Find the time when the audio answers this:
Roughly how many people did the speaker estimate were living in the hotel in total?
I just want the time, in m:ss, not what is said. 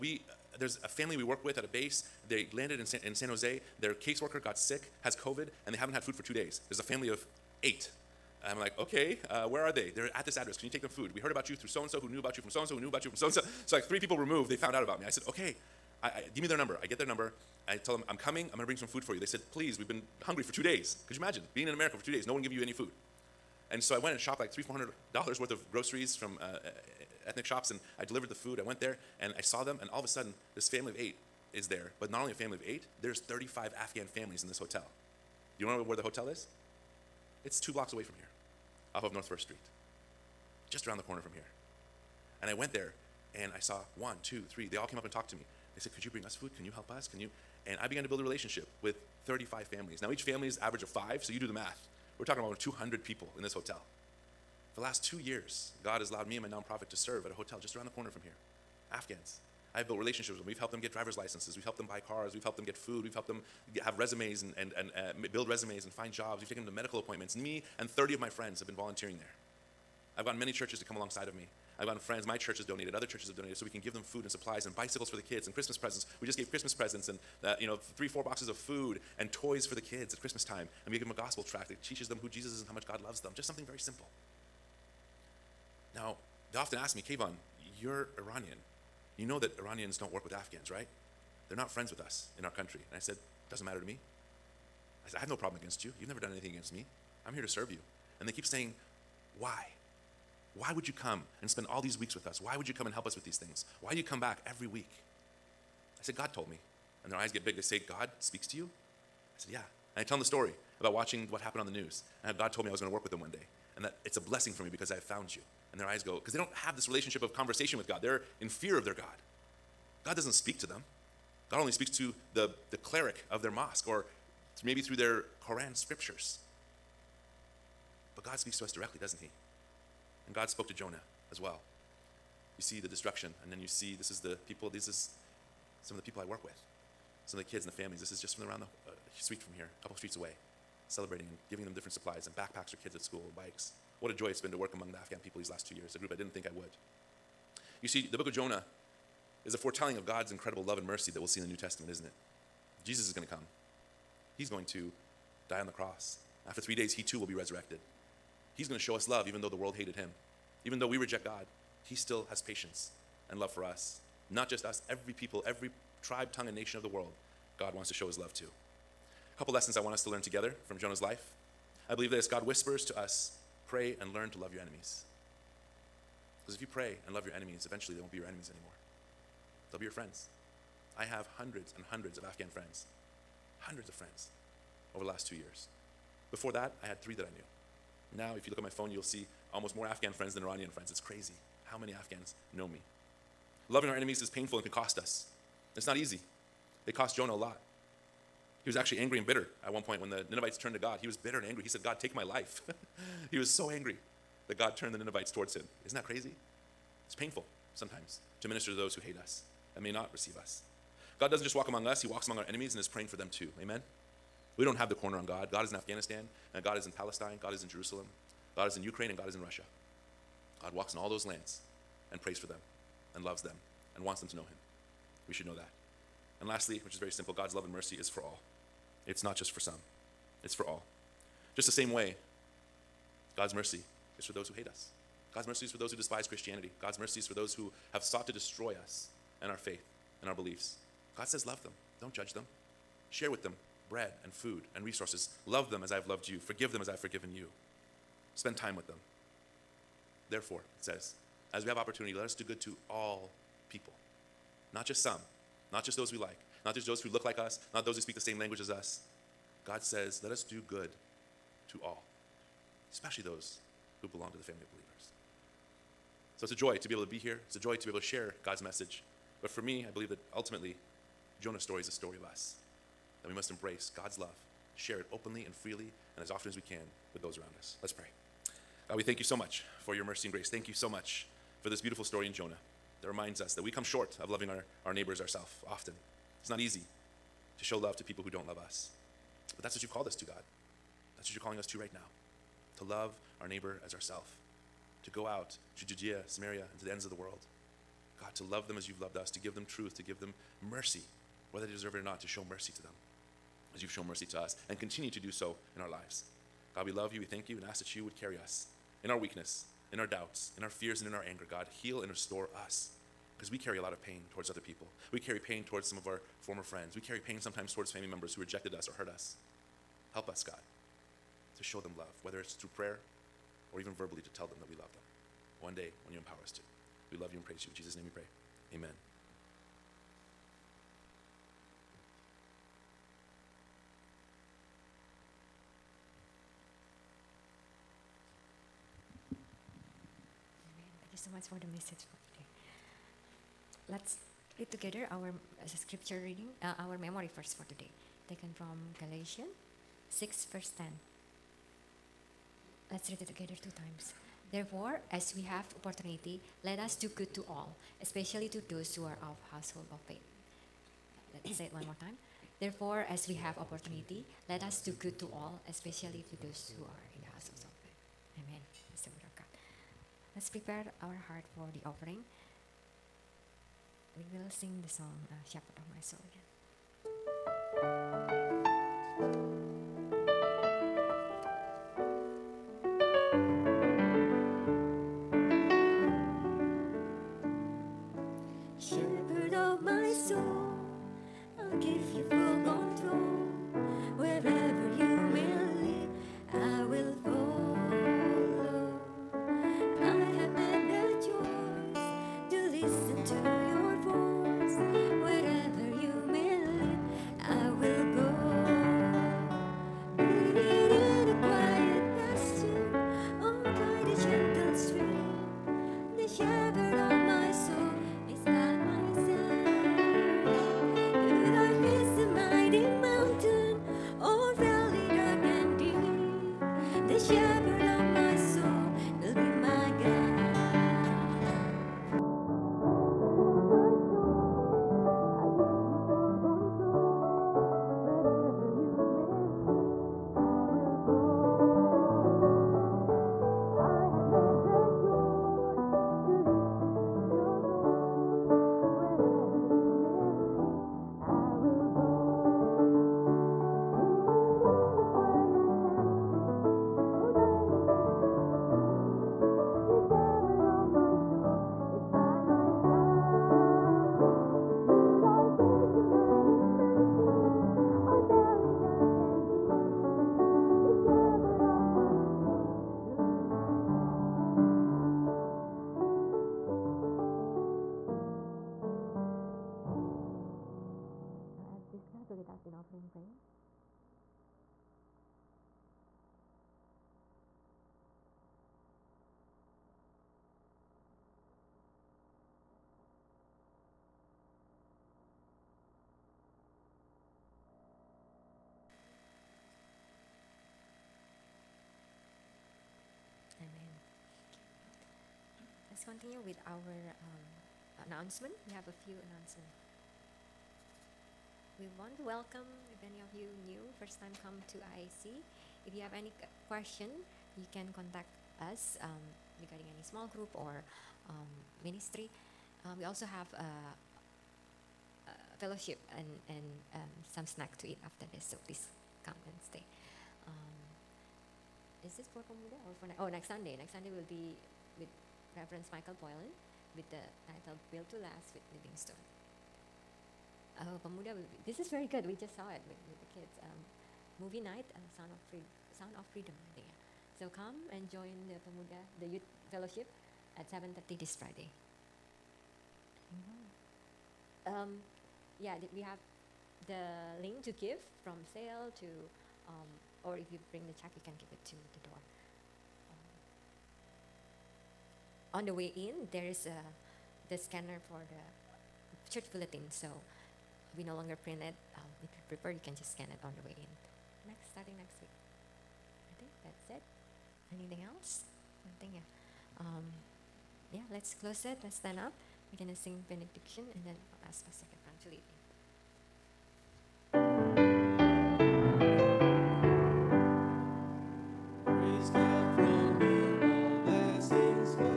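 0:52.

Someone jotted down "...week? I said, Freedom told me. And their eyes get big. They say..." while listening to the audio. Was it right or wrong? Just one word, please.
wrong.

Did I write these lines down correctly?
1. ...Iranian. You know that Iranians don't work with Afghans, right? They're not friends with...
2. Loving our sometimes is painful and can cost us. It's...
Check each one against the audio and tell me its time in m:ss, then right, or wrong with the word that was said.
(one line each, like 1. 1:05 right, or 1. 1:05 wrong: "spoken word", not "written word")
1. 1:28 right
2. 3:13 wrong: "enemies", not "sometimes".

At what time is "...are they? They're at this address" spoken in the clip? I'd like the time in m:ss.
0:09.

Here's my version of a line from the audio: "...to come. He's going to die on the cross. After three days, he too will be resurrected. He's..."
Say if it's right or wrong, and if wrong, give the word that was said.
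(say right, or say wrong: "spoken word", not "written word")
right.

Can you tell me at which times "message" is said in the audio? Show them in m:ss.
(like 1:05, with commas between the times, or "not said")
4:28, 5:41.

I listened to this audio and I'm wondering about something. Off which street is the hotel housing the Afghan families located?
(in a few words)
North First Street.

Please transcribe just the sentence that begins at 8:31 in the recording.
We want to welcome if any of you new, first time come to IEC.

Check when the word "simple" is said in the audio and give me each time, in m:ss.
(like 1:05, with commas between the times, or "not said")
1:23, 3:47.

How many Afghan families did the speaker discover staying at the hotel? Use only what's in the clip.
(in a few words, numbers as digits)
35.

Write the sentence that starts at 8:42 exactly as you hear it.
Um, we also have a uh, fellowship and, and um, some snack to eat after this.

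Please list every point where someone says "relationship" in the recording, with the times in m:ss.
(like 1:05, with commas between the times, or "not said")
0:48, 0:59, 1:56.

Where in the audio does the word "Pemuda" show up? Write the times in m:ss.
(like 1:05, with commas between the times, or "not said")
8:52, 9:01, 9:08.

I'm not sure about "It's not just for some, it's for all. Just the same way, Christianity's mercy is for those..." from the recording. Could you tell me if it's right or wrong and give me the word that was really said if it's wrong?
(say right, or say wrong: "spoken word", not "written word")
wrong: "God", not "Christianity".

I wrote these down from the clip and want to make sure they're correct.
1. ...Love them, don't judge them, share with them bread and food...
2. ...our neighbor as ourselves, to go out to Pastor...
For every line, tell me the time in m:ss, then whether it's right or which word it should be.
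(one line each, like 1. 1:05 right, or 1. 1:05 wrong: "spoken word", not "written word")
1. 4:01 right
2. 4:53 wrong: "Judea", not "Pastor".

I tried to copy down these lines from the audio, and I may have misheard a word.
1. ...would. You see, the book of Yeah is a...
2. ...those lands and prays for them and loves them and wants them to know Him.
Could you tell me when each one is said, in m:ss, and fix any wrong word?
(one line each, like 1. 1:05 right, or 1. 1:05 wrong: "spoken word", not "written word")
1. 2:26 wrong: "Jonah", not "Yeah"
2. 3:41 right.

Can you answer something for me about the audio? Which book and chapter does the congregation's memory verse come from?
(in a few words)
Galatians 6.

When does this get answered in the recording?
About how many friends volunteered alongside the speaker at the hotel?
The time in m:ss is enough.
1:07.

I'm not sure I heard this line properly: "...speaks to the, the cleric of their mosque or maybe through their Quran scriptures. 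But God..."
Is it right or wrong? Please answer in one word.
right.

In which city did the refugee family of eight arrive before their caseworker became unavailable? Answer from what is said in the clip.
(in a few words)
San Jose.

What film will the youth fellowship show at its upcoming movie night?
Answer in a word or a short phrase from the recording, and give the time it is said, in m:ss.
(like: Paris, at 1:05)
Sound of Freedom, at 9:05.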